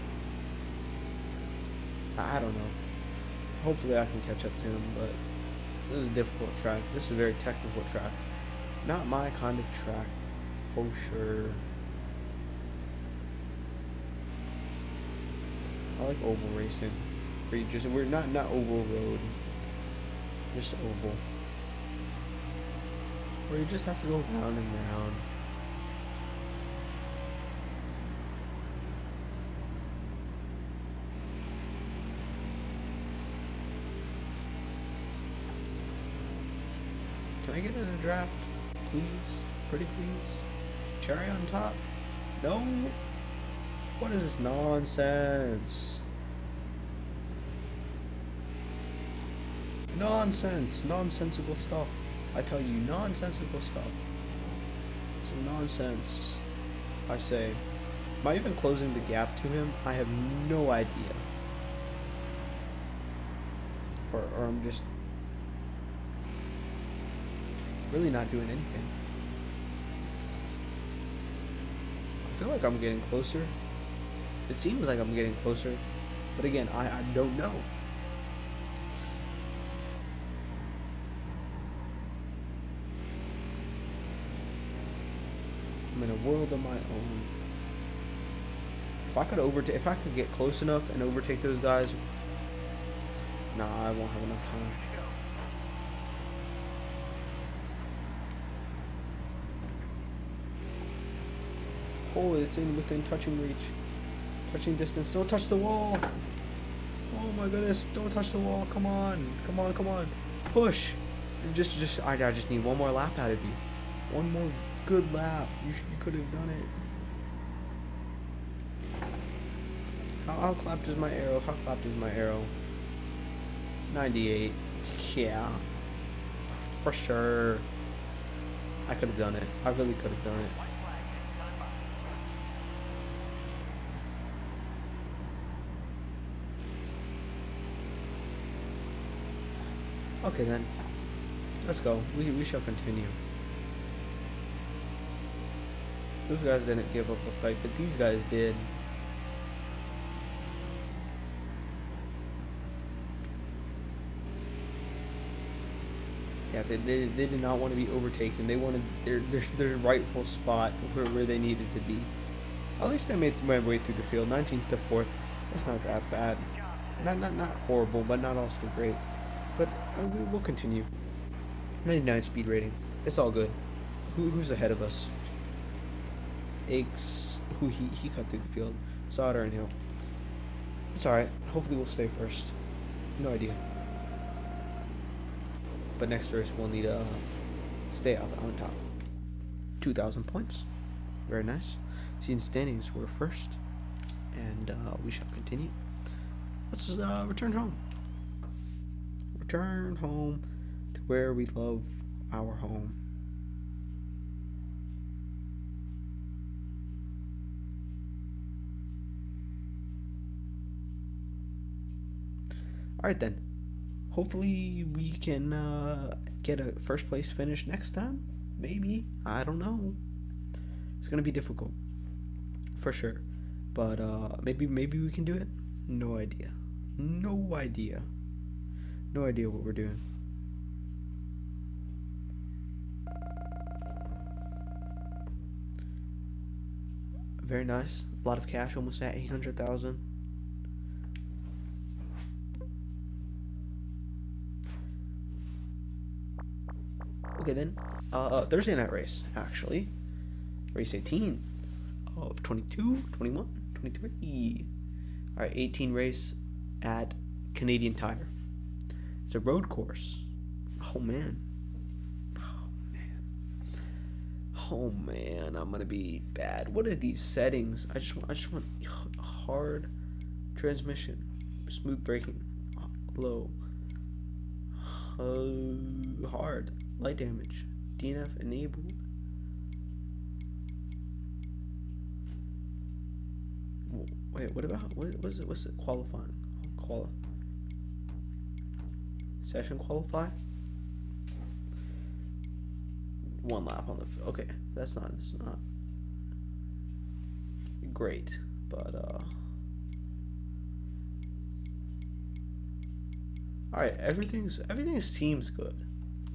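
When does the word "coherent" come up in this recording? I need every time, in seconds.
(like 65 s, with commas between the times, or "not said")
not said.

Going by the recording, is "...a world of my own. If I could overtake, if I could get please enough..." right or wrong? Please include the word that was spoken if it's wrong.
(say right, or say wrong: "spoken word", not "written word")
wrong: "close", not "please".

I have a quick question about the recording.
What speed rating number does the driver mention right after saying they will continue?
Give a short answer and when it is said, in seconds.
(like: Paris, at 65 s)
99, at 171 s.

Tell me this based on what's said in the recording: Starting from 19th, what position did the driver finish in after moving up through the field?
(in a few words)
4th.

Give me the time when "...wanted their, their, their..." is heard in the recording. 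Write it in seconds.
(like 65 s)
158 s.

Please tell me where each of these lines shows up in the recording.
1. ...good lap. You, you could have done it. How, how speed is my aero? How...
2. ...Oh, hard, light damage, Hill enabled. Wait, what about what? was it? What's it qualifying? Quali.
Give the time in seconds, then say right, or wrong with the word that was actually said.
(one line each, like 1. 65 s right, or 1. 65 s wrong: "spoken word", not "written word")
1. 114 s wrong: "clapped", not "speed"
2. 275 s wrong: "DNF", not "Hill".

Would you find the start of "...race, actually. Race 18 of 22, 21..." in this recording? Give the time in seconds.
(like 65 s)
248 s.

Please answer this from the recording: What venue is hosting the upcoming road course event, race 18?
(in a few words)
Canadian Tire.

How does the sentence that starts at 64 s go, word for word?
Or, or I'm just really not doing anything.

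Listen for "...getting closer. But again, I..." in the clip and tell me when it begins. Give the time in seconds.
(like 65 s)
75 s.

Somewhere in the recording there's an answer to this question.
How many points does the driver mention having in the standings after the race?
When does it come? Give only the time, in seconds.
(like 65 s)
189 s.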